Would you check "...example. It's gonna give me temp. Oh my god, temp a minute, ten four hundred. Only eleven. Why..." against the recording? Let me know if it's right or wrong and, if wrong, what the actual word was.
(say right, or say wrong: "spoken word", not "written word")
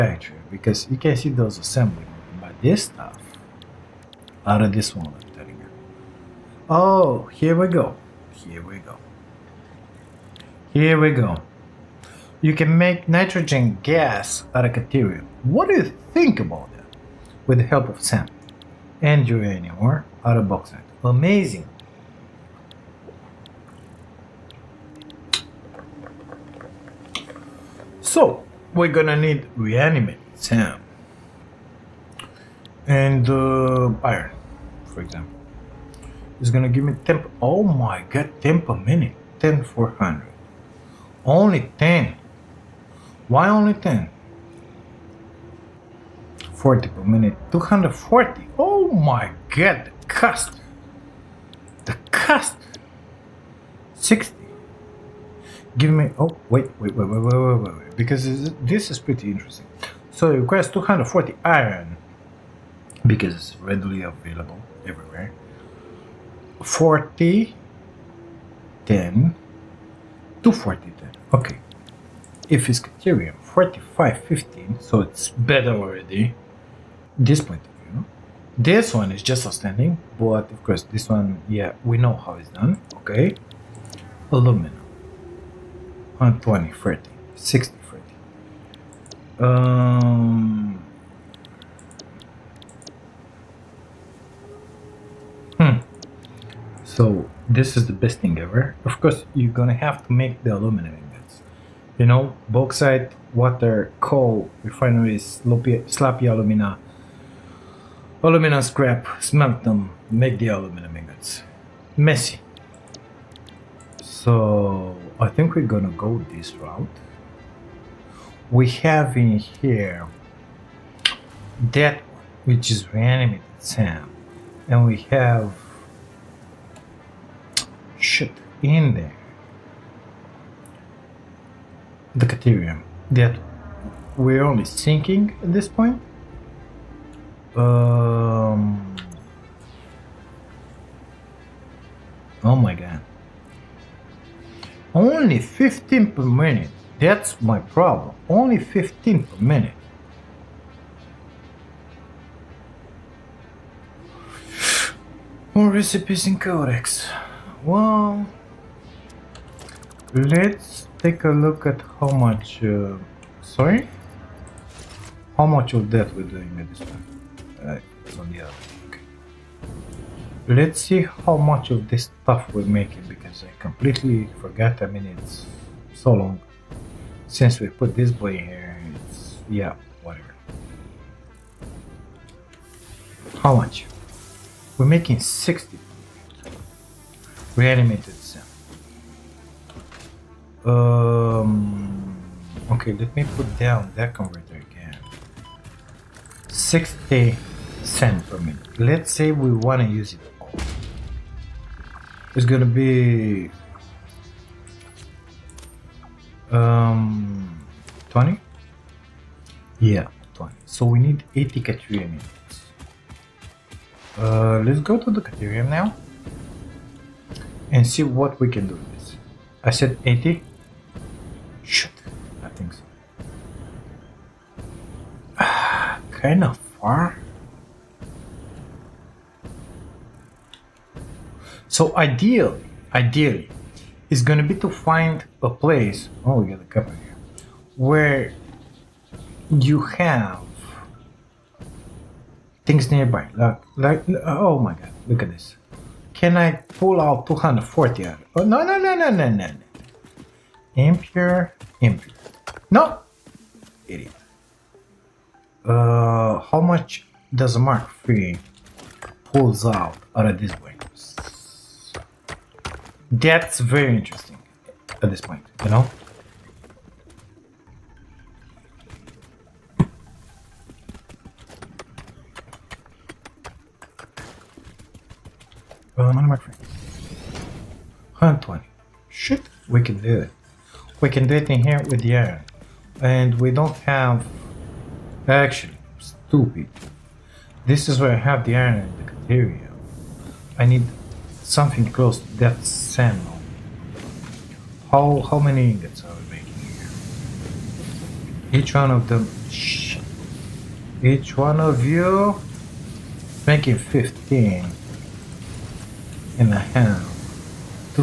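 wrong: "ten", not "eleven".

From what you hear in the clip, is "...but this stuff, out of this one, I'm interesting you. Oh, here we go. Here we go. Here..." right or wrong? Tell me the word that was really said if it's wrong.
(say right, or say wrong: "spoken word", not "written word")
wrong: "telling", not "interesting".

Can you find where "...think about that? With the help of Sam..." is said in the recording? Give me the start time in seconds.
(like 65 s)
16 s.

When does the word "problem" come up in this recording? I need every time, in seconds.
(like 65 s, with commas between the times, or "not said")
147 s.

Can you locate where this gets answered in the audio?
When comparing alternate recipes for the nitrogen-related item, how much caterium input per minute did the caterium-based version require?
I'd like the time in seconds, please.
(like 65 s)
72 s.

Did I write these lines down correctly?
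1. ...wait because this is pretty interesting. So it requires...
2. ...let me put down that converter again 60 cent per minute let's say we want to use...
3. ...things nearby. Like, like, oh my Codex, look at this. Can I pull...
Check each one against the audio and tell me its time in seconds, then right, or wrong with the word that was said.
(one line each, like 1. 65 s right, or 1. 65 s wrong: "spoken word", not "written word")
1. 57 s right
2. 192 s right
3. 242 s wrong: "God", not "Codex".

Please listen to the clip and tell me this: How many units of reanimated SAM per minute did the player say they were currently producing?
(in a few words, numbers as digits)
60.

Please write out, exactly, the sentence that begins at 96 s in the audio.
So this is the best thing ever.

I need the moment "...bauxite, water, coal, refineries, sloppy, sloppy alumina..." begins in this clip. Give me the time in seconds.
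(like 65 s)
102 s.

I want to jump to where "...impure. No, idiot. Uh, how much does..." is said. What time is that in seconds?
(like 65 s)
251 s.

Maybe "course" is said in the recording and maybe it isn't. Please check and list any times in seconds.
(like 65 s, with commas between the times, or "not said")
80 s, 99 s.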